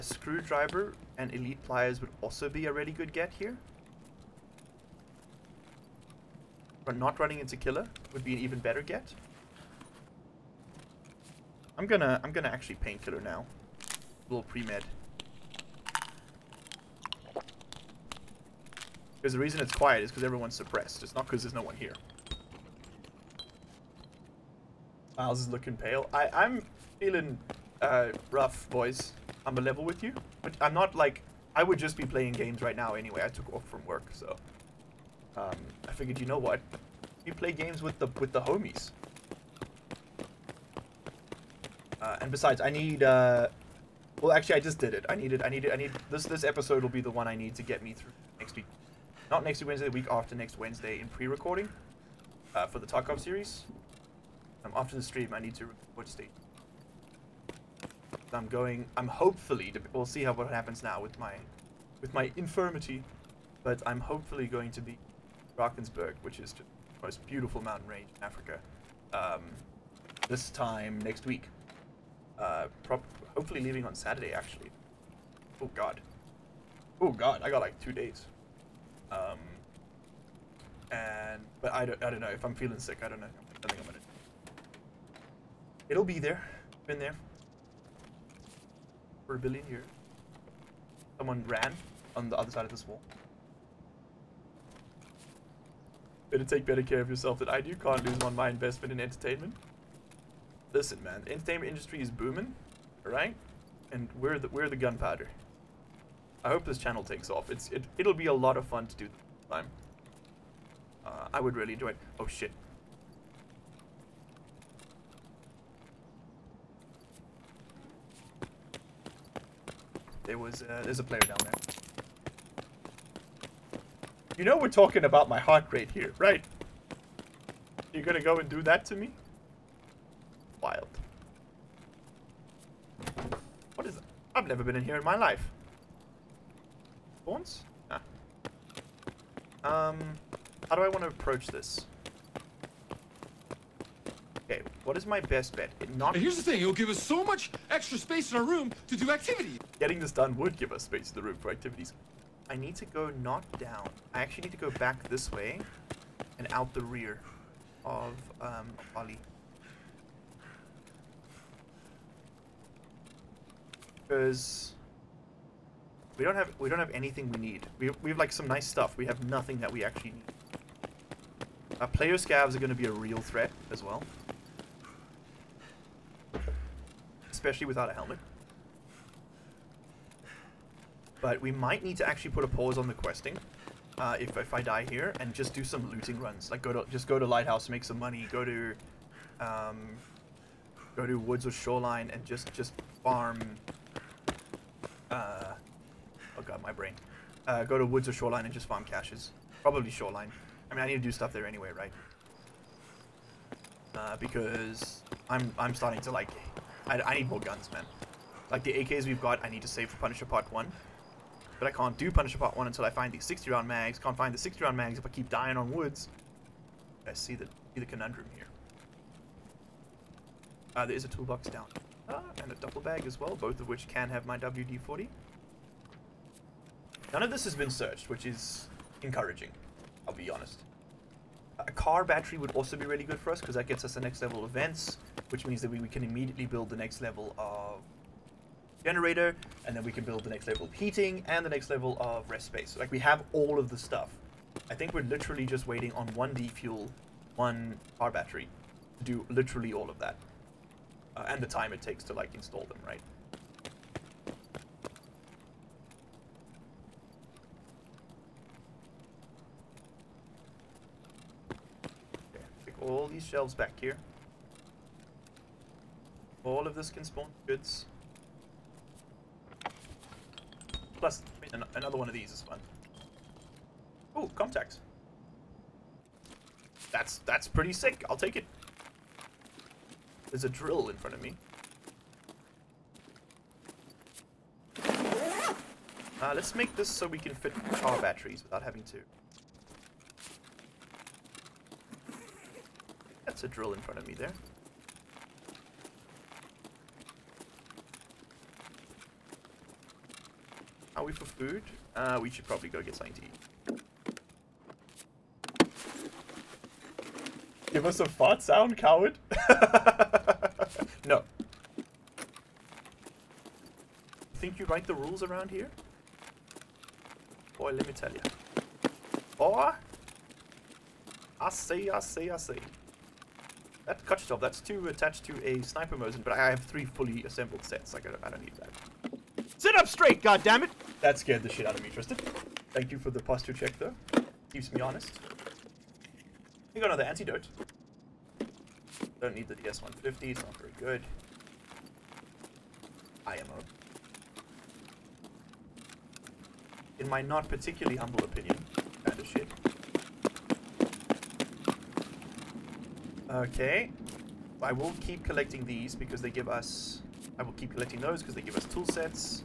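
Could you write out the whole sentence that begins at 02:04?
You know we're talking about my heart rate here, right?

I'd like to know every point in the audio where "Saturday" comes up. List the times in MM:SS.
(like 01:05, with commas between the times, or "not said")
01:13.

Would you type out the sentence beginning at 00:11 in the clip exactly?
I'm gonna I'm gonna actually painkiller now.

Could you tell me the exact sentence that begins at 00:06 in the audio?
But not running into Killa would be an even better get.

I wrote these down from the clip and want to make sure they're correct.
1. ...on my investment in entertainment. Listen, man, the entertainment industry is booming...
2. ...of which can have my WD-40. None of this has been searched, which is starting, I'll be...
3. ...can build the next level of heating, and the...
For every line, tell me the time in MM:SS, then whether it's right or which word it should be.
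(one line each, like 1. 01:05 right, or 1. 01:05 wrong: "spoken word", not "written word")
1. 01:38 right
2. 03:43 wrong: "encouraging", not "starting"
3. 03:59 right.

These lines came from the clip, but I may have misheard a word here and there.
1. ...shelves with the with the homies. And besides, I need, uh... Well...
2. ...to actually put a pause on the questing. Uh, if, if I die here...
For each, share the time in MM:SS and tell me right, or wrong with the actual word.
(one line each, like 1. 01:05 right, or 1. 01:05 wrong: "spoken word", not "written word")
1. 00:37 wrong: "games", not "shelves"
2. 03:01 right.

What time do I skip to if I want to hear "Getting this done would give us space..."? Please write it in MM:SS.
02:29.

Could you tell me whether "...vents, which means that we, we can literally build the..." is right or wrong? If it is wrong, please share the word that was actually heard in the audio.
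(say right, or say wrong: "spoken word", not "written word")
wrong: "immediately", not "literally".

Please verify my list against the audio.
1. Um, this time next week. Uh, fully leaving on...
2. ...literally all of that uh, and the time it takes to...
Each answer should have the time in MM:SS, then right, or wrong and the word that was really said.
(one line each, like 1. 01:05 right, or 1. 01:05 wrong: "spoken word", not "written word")
1. 01:09 wrong: "hopefully", not "fully"
2. 04:09 right.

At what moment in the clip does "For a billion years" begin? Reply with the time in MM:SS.
01:29.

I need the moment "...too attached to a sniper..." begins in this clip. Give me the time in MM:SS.
05:24.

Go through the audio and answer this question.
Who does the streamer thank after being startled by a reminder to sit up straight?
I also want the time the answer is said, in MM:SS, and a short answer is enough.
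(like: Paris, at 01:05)
Tristan, at 05:31.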